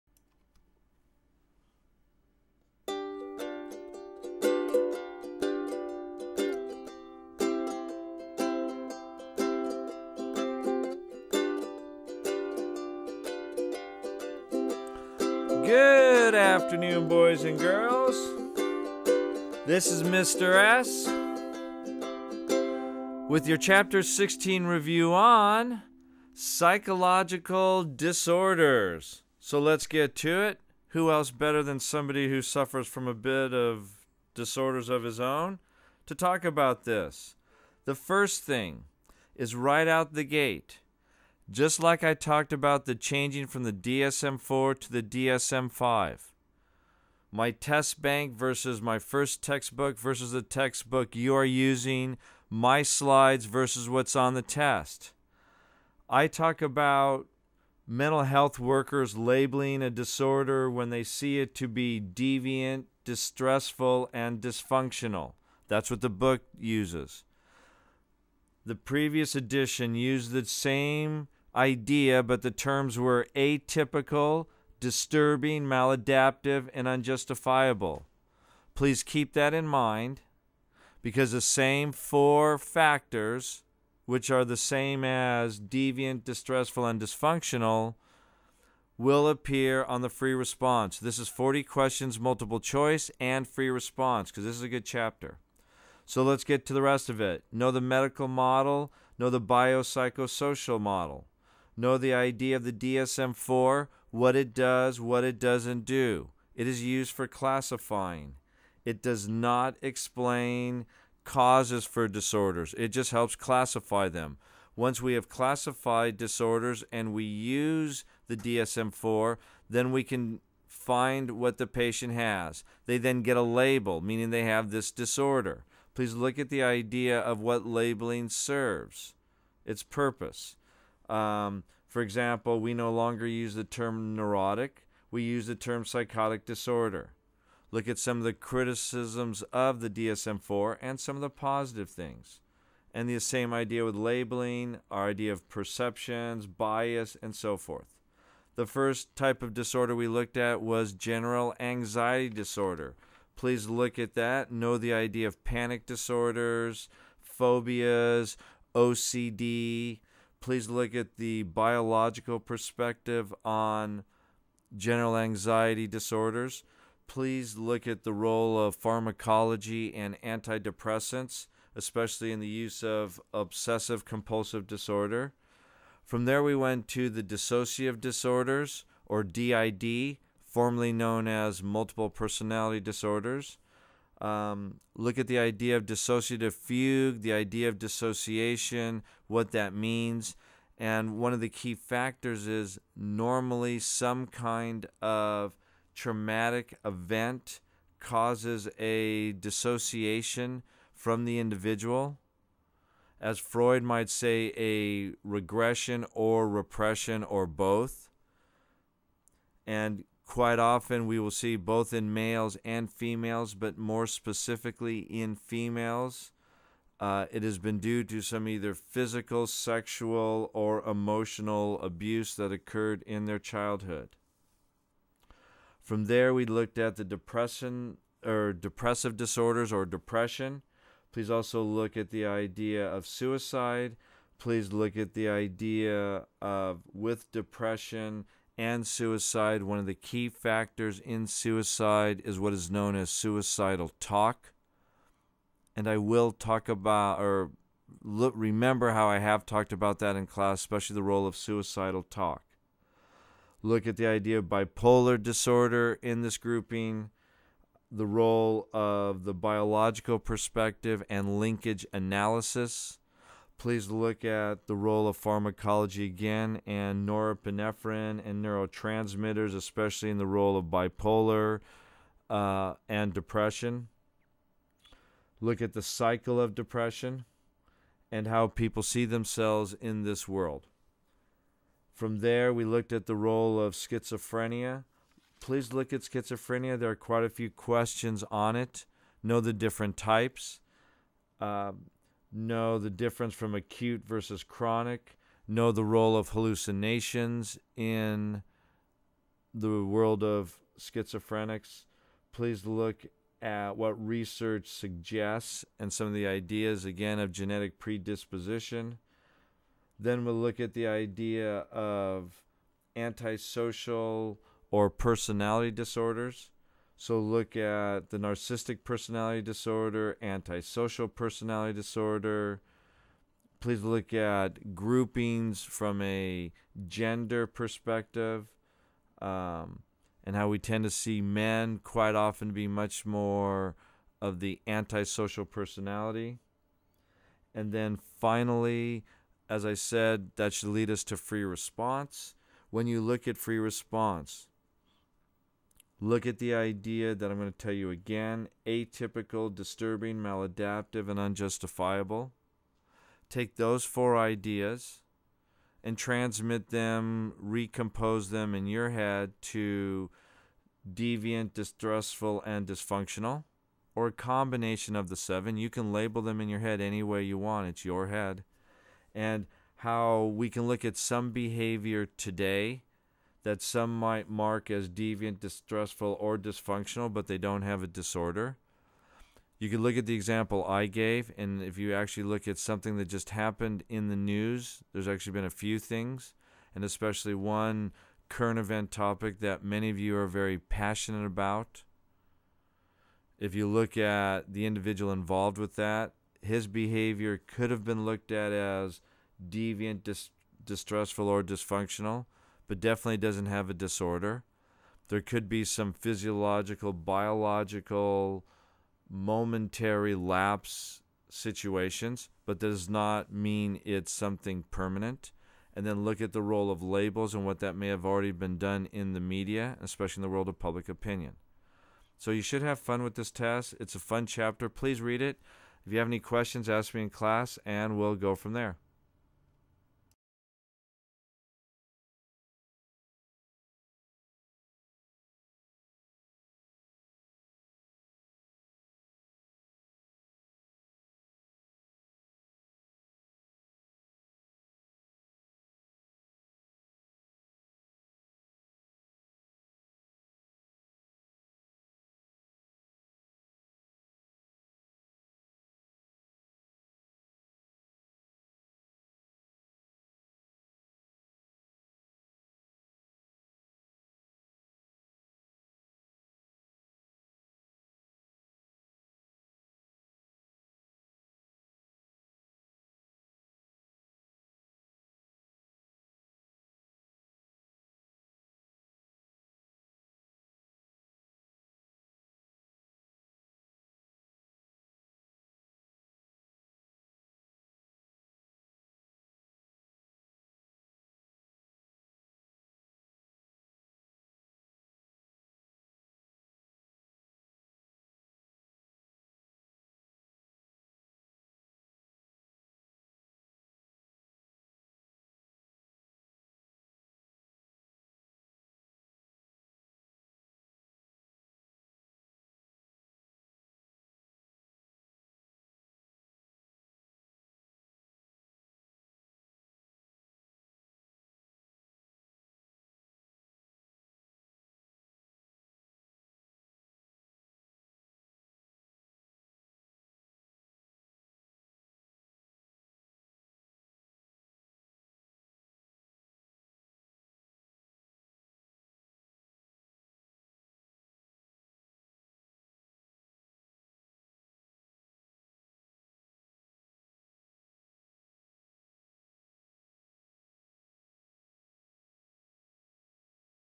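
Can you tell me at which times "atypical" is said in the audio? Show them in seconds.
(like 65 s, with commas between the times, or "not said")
73 s, 348 s.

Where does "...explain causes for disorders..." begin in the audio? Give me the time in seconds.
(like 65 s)
109 s.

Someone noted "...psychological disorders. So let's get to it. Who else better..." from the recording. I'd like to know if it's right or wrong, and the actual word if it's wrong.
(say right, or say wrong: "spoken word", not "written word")
right.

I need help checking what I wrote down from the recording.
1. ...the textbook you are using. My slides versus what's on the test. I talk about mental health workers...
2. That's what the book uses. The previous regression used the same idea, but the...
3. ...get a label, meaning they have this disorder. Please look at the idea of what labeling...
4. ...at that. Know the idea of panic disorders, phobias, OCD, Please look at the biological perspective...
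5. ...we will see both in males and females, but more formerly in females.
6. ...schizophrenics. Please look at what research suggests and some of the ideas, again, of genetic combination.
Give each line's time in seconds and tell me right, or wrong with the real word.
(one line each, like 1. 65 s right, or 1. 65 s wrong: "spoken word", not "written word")
1. 50 s right
2. 65 s wrong: "edition", not "regression"
3. 123 s right
4. 153 s right
5. 211 s wrong: "specifically", not "formerly"
6. 300 s wrong: "predisposition", not "combination".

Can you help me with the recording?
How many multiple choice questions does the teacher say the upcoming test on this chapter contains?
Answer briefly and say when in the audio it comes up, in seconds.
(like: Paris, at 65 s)
40, at 91 s.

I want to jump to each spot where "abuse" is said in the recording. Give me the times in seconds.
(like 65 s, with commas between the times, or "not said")
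221 s.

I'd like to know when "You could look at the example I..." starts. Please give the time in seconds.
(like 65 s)
379 s.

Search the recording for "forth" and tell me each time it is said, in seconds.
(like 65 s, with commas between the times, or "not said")
147 s.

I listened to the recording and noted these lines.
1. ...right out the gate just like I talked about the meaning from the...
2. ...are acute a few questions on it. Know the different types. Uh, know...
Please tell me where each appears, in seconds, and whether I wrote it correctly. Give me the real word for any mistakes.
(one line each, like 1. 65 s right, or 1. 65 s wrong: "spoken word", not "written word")
1. 39 s wrong: "changing", not "meaning"
2. 286 s wrong: "quite", not "acute".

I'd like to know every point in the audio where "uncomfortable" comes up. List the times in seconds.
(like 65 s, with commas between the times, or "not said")
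not said.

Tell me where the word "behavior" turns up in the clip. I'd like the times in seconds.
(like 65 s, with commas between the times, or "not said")
371 s, 396 s.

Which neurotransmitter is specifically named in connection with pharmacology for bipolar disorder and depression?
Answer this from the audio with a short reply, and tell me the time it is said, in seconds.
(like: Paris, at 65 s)
norepinephrine, at 267 s.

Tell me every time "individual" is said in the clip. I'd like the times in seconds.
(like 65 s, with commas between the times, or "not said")
201 s, 394 s.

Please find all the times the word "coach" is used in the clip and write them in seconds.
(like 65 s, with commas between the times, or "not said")
not said.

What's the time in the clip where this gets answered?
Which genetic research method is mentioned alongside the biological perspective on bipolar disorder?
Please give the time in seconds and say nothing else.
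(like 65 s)
261 s.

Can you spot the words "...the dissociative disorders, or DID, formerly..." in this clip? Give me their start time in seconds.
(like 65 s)
177 s.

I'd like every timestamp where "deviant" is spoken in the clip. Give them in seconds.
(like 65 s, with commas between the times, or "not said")
61 s, 85 s, 360 s, 374 s, 399 s.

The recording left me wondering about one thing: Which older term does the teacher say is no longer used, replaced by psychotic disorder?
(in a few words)
neurotic.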